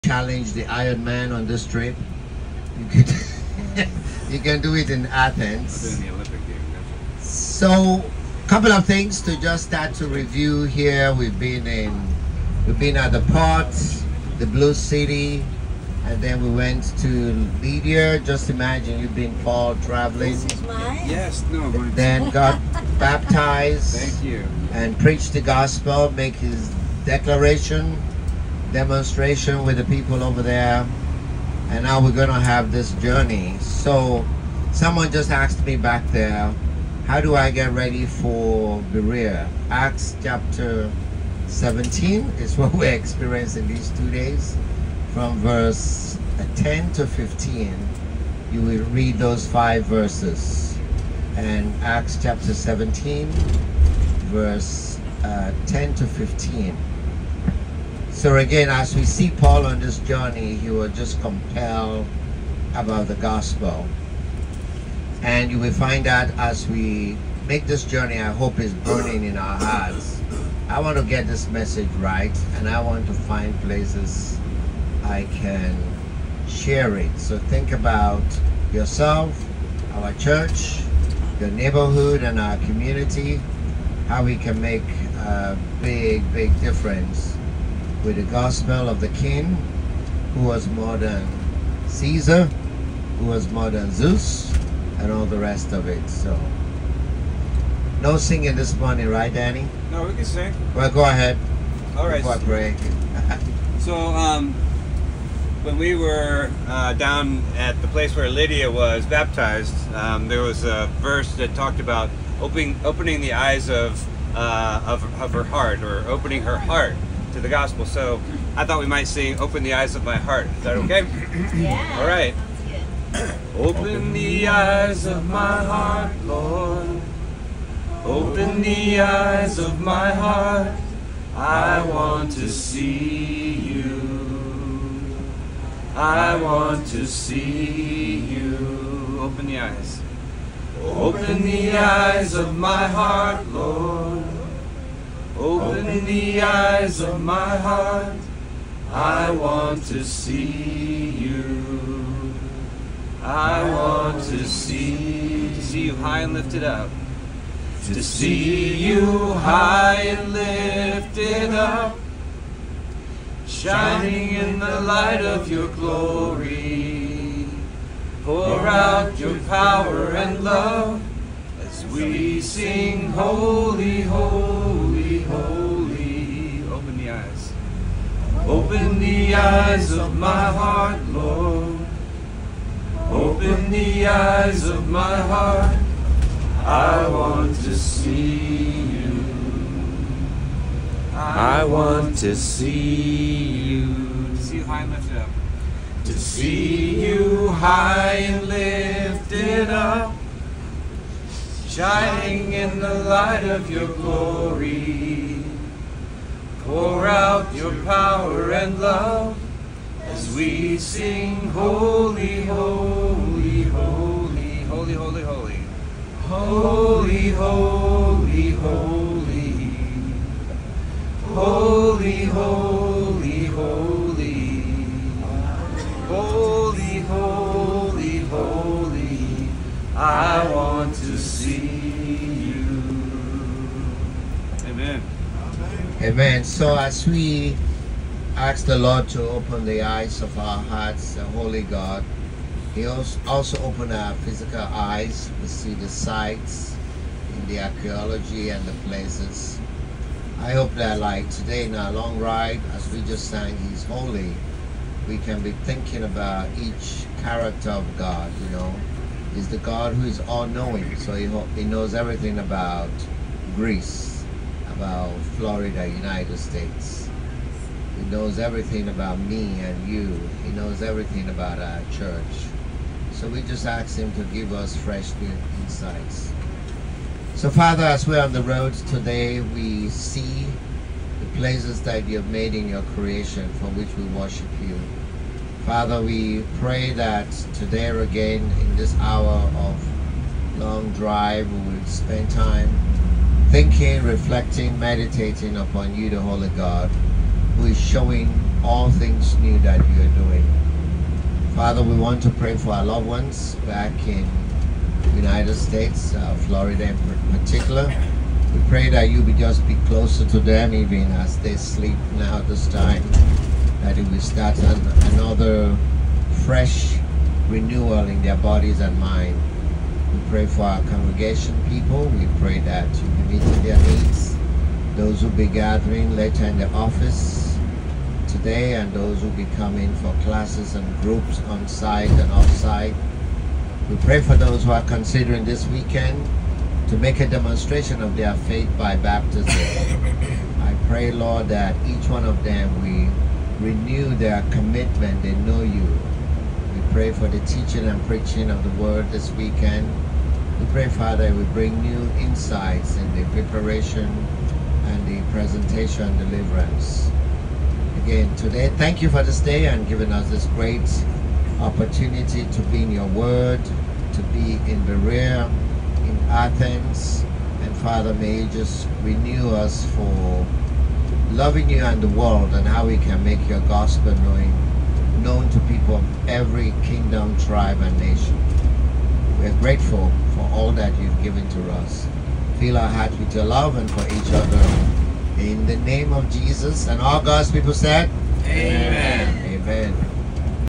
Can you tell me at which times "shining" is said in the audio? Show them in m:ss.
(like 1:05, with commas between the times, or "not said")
2:43, 3:21.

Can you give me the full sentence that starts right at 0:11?
We've been in, we've been at the port, the Blue City, and then we went to Lydia.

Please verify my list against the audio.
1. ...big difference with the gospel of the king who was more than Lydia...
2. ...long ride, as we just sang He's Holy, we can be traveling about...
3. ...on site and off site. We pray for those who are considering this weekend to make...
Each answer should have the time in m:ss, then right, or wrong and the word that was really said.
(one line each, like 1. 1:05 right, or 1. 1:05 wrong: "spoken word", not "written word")
1. 1:26 wrong: "Caesar", not "Lydia"
2. 4:11 wrong: "thinking", not "traveling"
3. 5:31 right.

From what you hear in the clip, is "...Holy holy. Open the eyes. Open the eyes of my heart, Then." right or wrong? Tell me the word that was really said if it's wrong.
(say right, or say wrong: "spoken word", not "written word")
wrong: "Lord", not "Then".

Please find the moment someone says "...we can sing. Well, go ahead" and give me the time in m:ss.
1:40.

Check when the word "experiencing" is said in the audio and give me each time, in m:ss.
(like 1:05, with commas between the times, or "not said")
0:42.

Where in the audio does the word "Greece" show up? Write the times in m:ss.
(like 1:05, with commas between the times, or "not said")
4:23.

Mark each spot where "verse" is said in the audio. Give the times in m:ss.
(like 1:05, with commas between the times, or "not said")
0:45, 0:49, 0:54, 1:51.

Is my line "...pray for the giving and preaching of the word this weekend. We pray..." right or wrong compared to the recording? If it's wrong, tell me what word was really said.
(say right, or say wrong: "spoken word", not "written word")
wrong: "teaching", not "giving".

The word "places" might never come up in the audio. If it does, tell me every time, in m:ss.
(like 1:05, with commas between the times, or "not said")
1:13, 1:47, 4:08, 4:41.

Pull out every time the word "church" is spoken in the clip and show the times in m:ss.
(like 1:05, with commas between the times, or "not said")
1:20, 4:31.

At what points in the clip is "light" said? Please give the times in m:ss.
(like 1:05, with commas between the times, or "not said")
2:44, 3:23.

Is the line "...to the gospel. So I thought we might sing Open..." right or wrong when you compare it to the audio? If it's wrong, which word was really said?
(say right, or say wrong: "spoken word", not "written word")
right.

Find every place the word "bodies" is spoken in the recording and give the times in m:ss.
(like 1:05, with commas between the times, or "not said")
5:18.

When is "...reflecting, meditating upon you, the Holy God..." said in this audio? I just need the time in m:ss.
4:54.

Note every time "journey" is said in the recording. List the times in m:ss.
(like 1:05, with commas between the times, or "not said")
0:32, 0:59, 1:07.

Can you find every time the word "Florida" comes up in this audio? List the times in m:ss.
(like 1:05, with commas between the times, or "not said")
4:25, 5:06.